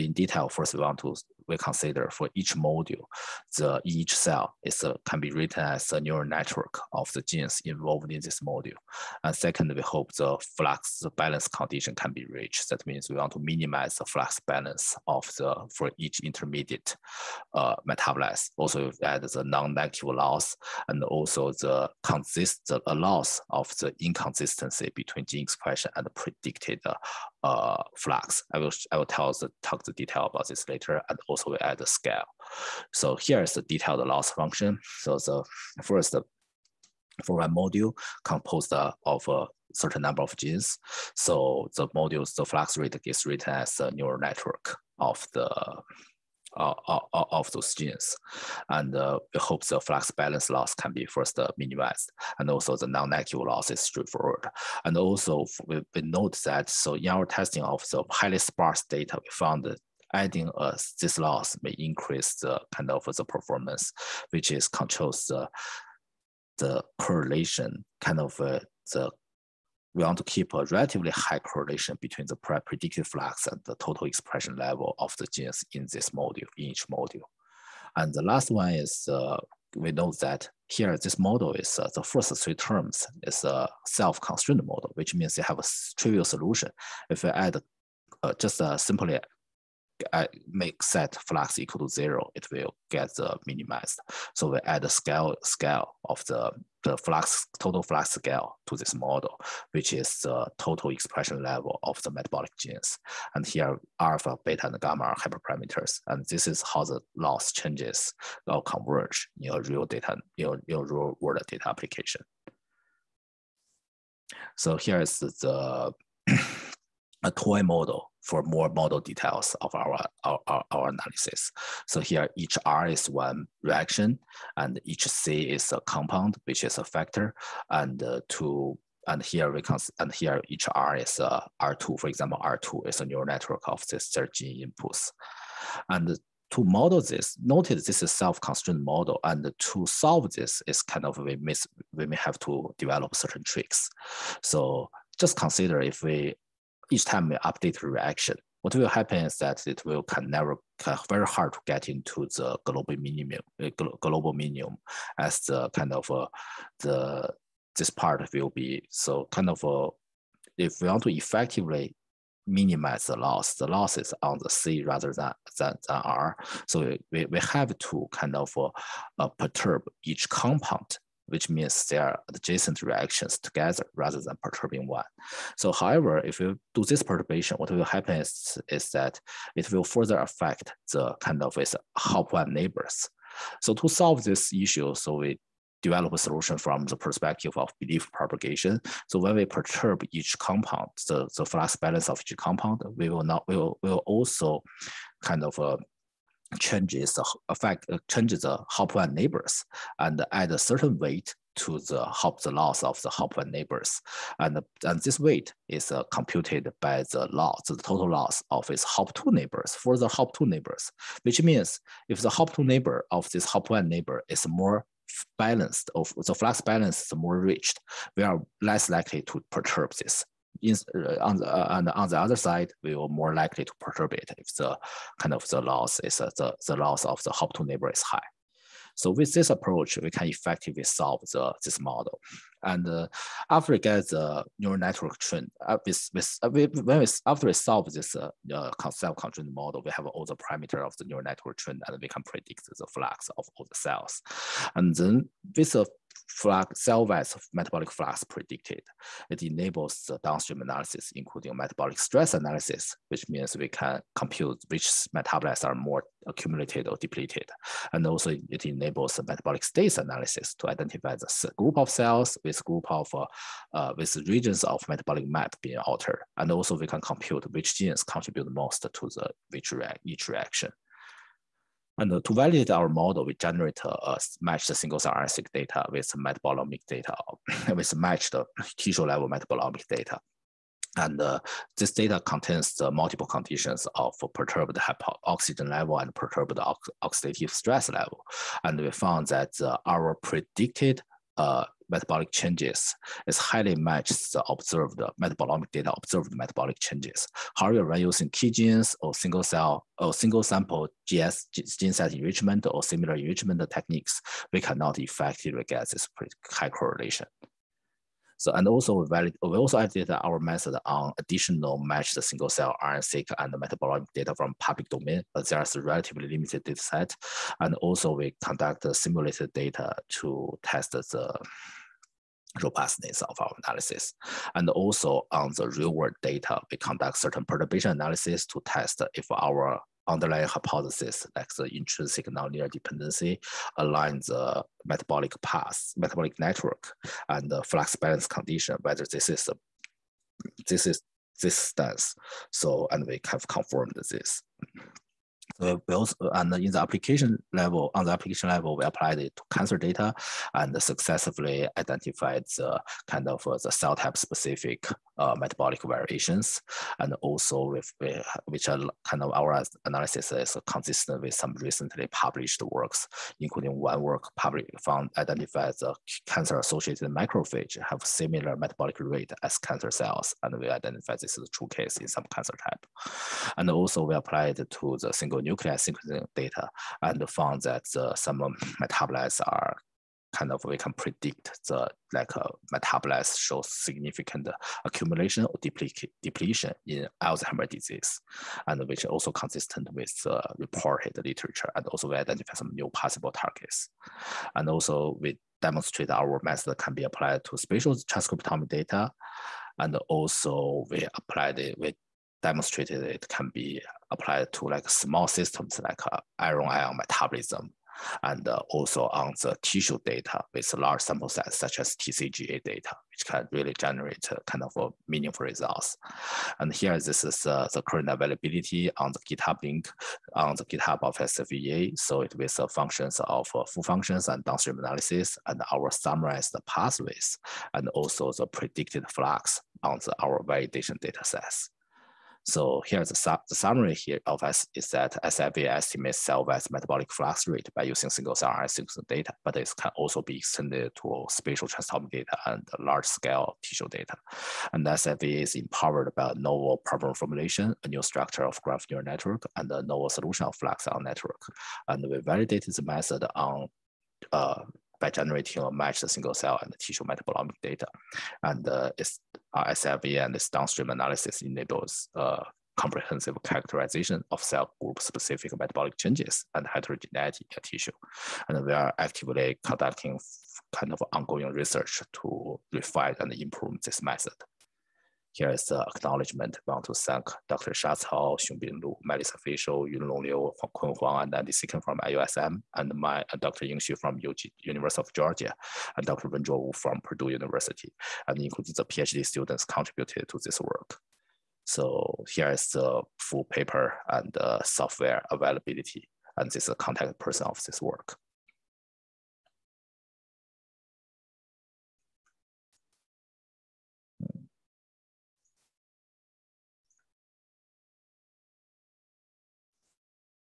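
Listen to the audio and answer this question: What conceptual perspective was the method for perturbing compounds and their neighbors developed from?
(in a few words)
Belief propagation.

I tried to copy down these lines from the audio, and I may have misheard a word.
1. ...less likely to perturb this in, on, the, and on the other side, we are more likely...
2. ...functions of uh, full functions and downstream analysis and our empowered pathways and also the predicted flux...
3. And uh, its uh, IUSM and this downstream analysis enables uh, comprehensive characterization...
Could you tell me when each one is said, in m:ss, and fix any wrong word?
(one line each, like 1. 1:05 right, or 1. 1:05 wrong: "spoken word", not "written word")
1. 3:38 right
2. 7:02 wrong: "summarized", not "empowered"
3. 7:38 wrong: "SLV", not "IUSM".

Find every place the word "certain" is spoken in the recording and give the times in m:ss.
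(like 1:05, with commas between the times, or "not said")
0:39, 2:23, 3:20, 5:27.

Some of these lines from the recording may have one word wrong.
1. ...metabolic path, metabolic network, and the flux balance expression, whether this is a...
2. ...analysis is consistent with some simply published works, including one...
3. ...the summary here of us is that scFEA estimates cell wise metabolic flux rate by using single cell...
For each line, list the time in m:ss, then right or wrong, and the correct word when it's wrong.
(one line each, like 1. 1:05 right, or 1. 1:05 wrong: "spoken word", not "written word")
1. 5:34 wrong: "condition", not "expression"
2. 5:59 wrong: "recently", not "simply"
3. 7:13 right.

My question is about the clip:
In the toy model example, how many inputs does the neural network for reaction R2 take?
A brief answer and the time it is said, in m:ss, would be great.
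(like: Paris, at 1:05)
13, at 2:14.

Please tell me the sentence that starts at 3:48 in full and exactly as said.
So with this approach, we can effectively solve the, this model.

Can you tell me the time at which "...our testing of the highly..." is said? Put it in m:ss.
0:57.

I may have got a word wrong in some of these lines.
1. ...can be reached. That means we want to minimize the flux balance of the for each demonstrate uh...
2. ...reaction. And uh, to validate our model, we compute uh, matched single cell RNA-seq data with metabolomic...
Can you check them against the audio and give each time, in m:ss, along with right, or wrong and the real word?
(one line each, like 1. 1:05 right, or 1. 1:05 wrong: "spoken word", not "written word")
1. 0:11 wrong: "intermediate", not "demonstrate"
2. 4:30 wrong: "generate", not "compute".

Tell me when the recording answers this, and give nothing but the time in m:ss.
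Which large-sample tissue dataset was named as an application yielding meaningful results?
6:51.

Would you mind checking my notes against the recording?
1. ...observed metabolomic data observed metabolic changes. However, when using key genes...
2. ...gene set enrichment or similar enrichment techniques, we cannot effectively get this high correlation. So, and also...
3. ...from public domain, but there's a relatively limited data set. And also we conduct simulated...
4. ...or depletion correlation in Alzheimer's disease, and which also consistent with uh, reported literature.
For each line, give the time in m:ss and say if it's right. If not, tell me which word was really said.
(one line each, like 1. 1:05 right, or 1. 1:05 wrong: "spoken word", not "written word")
1. 4:54 right
2. 5:01 right
3. 5:14 right
4. 6:25 wrong: "depletion", not "correlation".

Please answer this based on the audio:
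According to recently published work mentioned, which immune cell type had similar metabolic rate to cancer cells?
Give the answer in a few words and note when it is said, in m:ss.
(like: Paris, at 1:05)
Macrophage, at 6:07.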